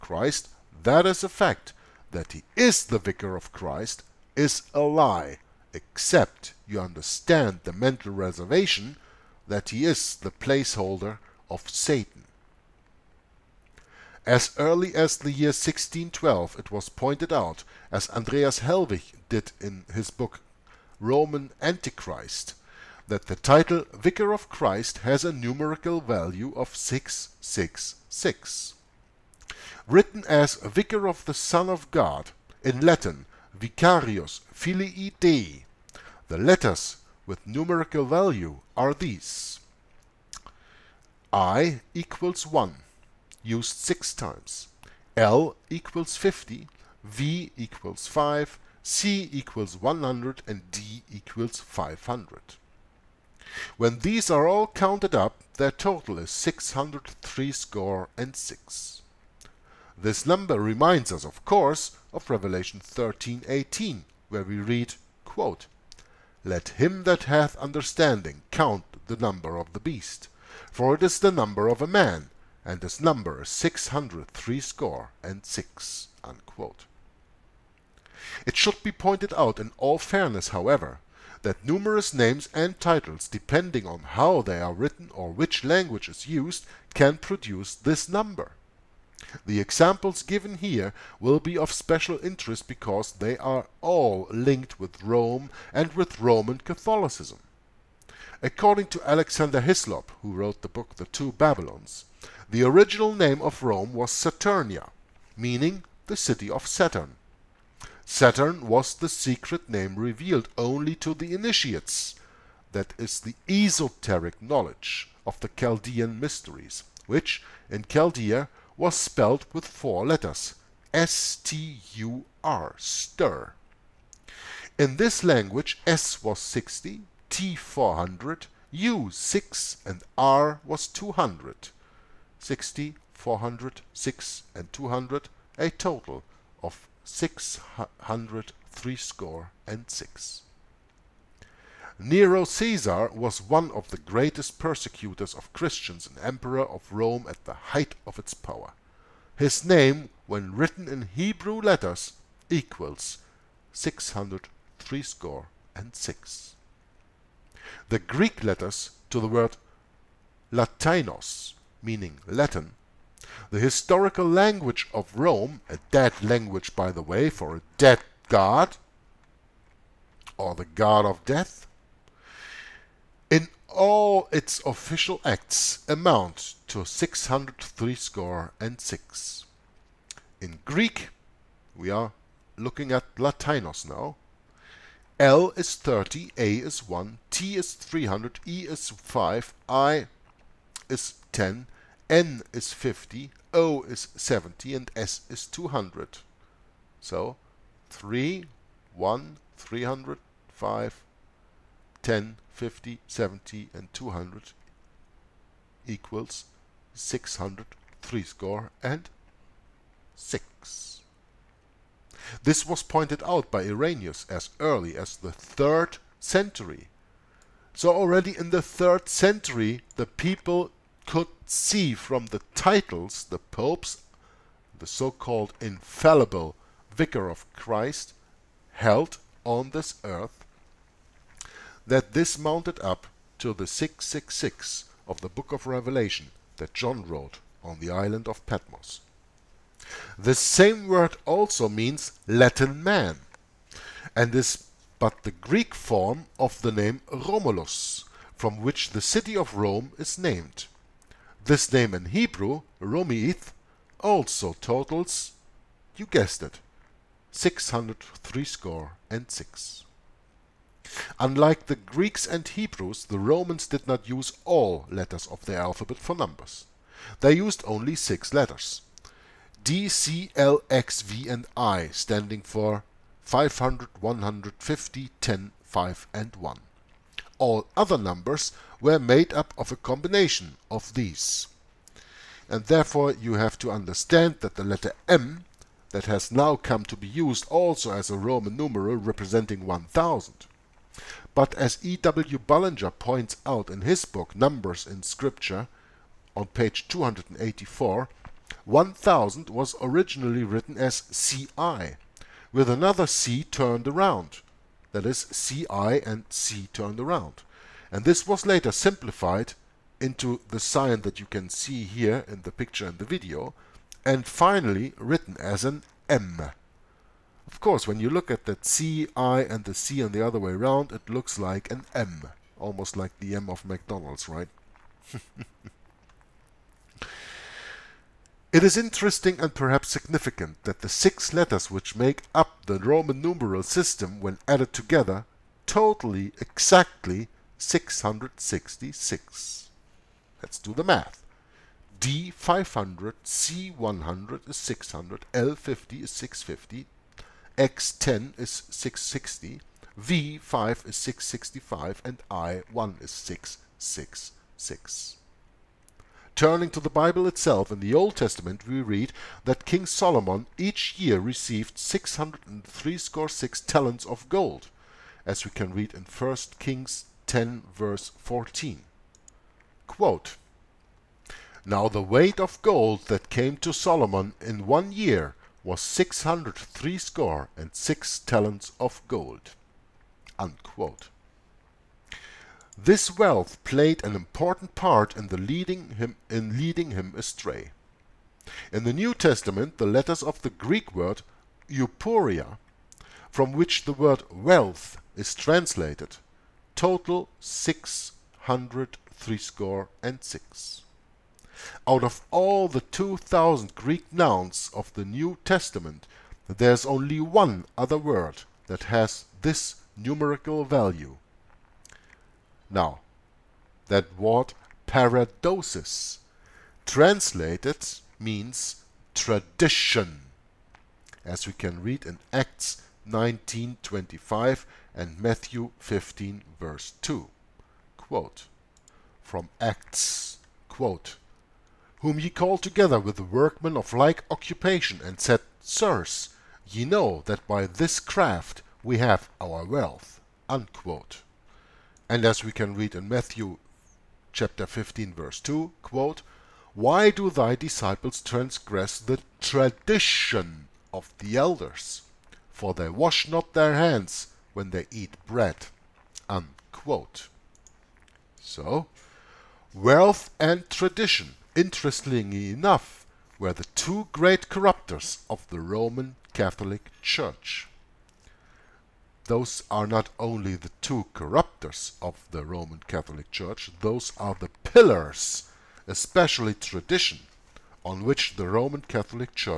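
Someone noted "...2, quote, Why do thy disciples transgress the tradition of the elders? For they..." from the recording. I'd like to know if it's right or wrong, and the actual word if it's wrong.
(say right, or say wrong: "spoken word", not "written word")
right.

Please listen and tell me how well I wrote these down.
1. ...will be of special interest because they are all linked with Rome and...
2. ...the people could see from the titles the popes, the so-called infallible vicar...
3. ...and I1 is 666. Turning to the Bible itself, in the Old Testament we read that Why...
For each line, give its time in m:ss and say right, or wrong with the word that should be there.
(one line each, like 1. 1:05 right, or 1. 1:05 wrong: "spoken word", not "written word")
1. 1:31 right
2. 3:39 right
3. 5:52 wrong: "King", not "Why".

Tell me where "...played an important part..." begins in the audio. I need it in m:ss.
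6:23.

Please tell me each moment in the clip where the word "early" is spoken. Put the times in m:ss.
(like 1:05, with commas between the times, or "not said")
0:14, 3:34.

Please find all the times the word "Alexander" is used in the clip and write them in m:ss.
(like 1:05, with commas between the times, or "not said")
1:39.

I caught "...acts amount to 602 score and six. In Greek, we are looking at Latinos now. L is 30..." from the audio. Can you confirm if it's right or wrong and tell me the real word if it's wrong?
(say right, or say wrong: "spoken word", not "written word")
wrong: "603", not "602".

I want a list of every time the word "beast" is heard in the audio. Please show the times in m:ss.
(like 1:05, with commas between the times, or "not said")
1:09.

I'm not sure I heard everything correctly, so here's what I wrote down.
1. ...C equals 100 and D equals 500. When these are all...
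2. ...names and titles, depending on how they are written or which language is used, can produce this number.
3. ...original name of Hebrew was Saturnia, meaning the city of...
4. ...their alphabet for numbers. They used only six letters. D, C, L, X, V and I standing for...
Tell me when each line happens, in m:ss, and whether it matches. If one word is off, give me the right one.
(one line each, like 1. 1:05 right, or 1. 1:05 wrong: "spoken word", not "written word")
1. 0:48 right
2. 1:22 right
3. 1:42 wrong: "Rome", not "Hebrew"
4. 4:25 right.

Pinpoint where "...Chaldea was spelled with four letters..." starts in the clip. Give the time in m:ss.
1:57.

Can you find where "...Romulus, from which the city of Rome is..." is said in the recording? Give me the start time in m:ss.
4:07.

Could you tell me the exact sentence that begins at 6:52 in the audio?
Now, that word paradosis translated means tradition, as we can read in Acts 19:25 and Matthew 15 verse 2.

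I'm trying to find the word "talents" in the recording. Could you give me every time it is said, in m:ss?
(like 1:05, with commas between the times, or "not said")
6:03, 6:18.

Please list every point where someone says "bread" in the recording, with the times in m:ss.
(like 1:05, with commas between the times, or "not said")
7:35.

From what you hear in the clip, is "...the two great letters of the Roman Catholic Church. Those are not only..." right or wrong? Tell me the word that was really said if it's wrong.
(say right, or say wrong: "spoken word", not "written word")
wrong: "corruptors", not "letters".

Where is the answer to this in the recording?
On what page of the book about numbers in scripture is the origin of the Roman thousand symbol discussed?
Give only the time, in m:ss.
4:56.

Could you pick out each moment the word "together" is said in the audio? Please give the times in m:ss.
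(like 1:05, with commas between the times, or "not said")
5:34, 7:12.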